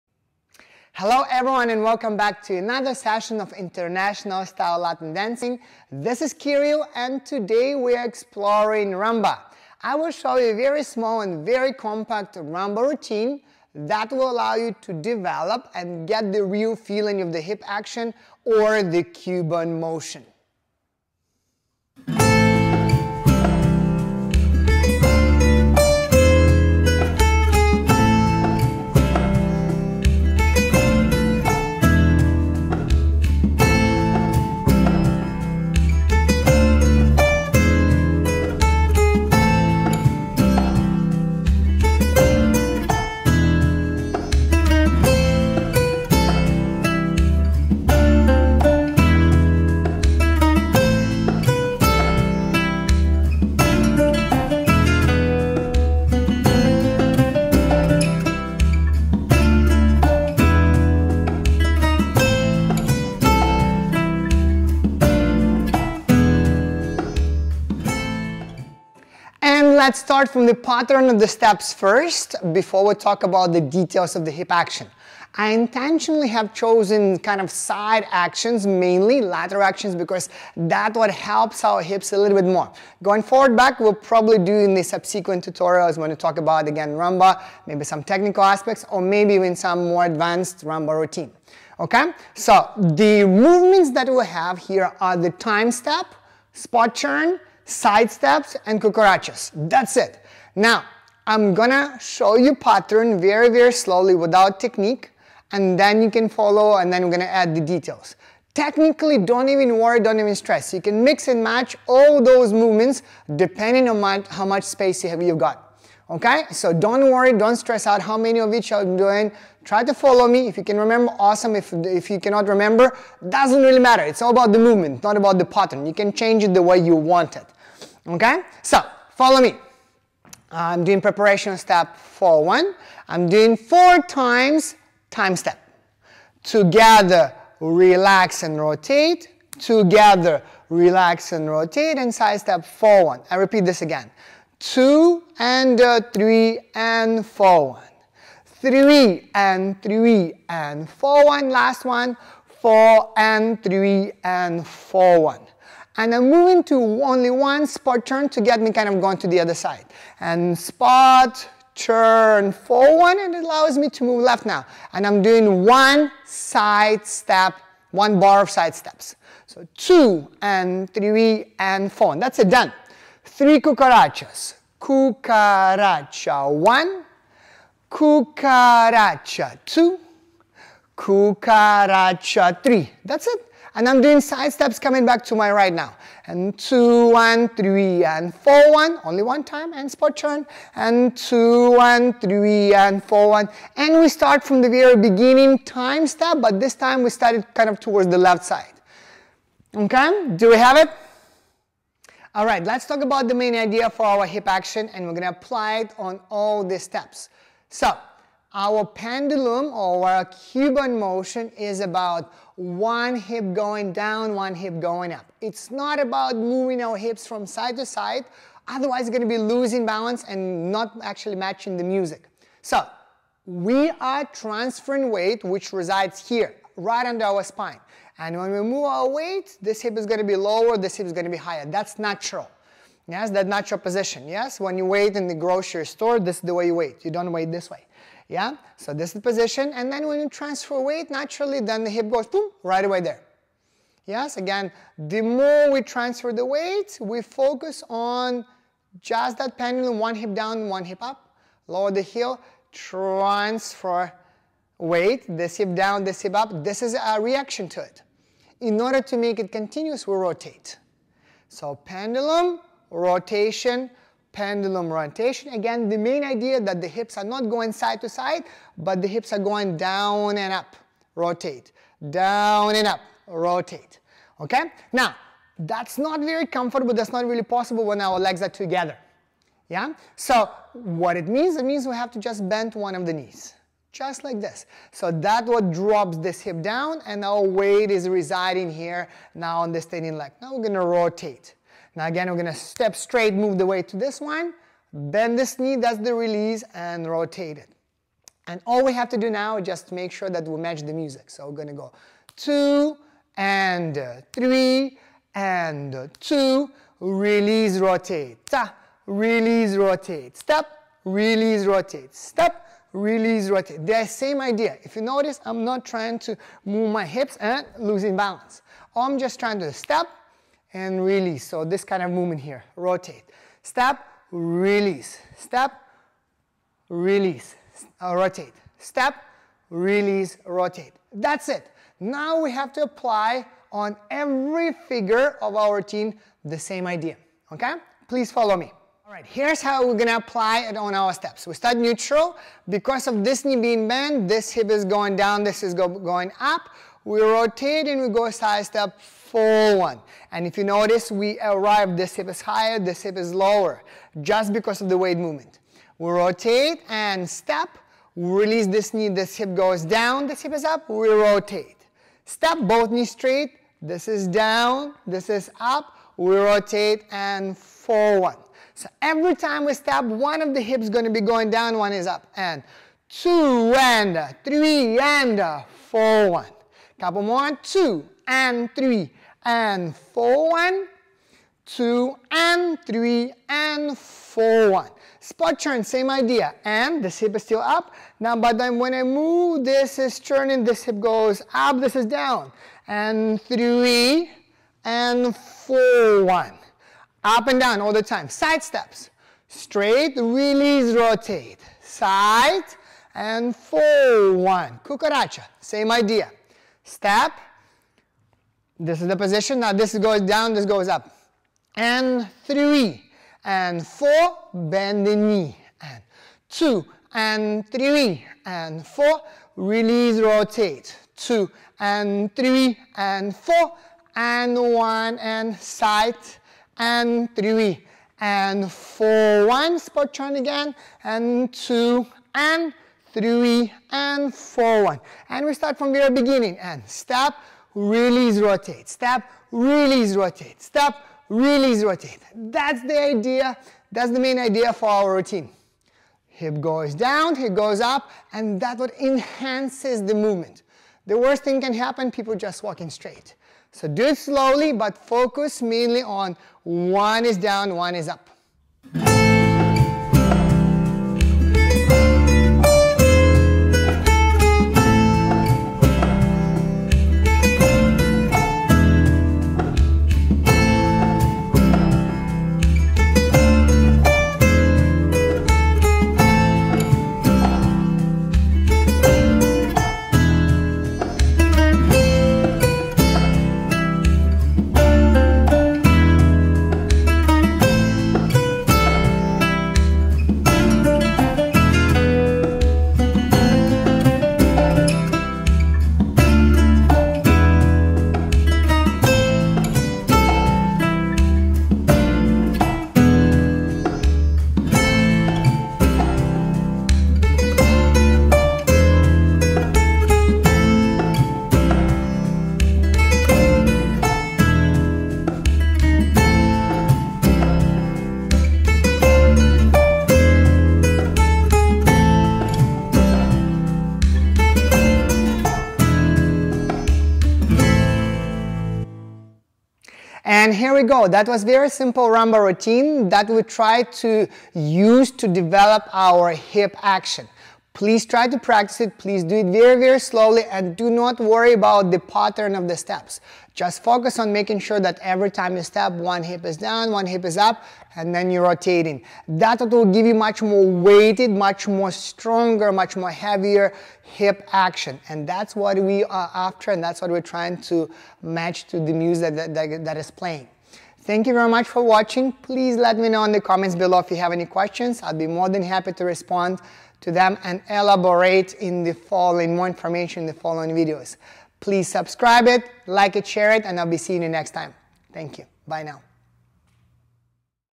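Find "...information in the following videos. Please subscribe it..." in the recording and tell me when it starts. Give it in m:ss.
9:29.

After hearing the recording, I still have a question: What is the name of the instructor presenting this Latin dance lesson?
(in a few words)
Kyryl.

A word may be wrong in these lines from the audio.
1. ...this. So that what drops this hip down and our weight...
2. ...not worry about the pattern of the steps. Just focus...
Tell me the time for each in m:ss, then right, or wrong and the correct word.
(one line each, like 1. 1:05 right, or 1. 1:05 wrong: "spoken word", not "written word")
1. 4:44 right
2. 9:00 right.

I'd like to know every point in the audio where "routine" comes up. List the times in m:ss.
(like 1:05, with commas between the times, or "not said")
0:12, 1:30, 5:35, 7:25, 8:52.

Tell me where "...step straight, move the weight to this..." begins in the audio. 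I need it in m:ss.
4:52.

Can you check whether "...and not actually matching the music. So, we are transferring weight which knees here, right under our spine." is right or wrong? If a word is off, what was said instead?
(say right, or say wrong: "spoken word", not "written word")
wrong: "resides", not "knees".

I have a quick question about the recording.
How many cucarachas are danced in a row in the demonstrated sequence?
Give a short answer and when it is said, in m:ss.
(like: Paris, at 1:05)
3, at 2:53.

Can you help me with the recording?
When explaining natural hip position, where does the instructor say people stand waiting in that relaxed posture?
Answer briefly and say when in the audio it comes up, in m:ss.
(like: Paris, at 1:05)
Grocery store, at 3:55.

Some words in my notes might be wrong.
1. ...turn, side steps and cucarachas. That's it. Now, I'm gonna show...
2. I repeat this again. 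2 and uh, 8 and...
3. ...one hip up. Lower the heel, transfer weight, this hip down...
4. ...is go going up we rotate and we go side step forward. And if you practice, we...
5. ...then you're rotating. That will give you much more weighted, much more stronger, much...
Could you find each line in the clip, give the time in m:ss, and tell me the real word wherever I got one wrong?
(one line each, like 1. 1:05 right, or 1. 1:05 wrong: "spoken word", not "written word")
1. 1:36 right
2. 2:23 wrong: "3", not "8"
3. 4:10 right
4. 5:45 wrong: "notice", not "practice"
5. 9:08 right.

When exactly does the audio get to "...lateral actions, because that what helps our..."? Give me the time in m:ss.
1:19.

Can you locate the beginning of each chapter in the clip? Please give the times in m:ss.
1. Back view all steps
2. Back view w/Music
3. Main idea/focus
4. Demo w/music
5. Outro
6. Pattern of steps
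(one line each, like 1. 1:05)
1. 5:39
2. 7:39
3. 3:22
4. 0:21
5. 8:49
6. 1:09.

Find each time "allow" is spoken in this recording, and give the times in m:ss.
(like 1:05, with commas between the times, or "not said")
0:14, 2:43.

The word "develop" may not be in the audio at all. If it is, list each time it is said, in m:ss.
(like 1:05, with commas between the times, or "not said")
0:14, 8:55.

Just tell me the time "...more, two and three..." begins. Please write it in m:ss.
6:17.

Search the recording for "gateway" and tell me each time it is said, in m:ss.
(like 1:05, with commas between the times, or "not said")
not said.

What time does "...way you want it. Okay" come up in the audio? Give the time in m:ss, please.
2:06.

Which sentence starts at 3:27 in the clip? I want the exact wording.
So, our pendulum or our Cuban motion is about one hip going down, one hip going up.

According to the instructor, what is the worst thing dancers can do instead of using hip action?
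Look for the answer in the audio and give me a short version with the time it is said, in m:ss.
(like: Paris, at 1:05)
Walking straight, at 7:32.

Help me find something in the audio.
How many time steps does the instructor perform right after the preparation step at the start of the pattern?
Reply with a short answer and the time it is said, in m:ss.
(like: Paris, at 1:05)
4, at 2:13.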